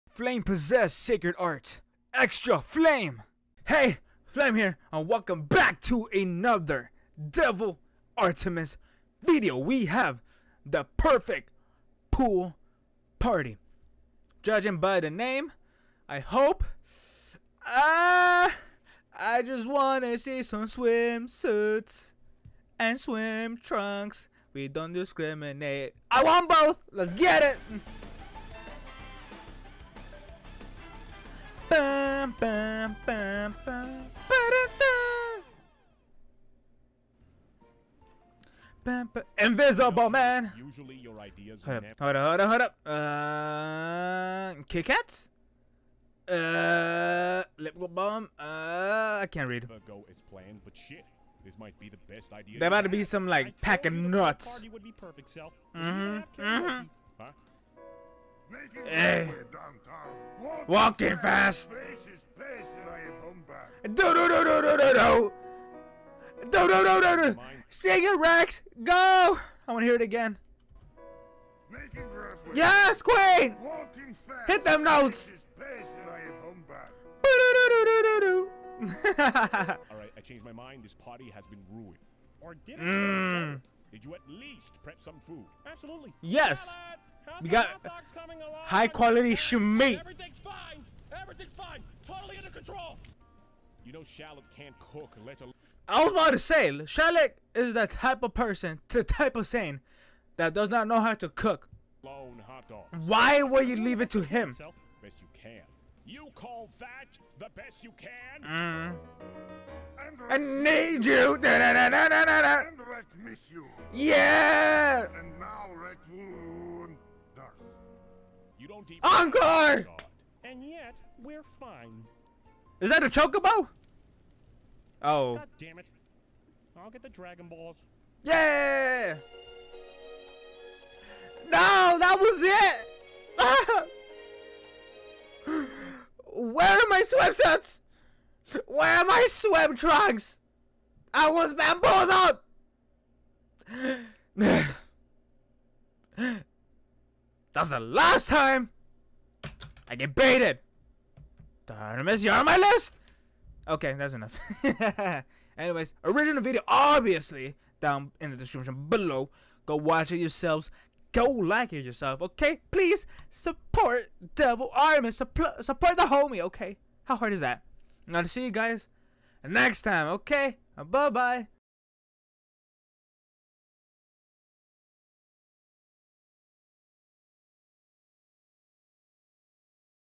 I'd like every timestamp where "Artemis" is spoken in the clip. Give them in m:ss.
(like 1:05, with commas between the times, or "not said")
0:08, 2:31, 2:44.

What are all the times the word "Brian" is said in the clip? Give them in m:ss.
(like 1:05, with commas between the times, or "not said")
not said.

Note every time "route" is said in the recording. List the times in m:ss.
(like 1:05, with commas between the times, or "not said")
not said.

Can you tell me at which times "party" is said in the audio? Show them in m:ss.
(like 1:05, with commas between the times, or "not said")
0:13, 0:54, 1:20.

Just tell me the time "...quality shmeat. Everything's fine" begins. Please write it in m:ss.
1:28.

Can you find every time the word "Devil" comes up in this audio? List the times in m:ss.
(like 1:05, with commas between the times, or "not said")
0:07, 2:44.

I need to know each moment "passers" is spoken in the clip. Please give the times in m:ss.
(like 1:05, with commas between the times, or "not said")
not said.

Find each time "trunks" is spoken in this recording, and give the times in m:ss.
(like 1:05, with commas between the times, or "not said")
0:23, 2:19.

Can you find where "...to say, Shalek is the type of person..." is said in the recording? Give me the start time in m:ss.
1:36.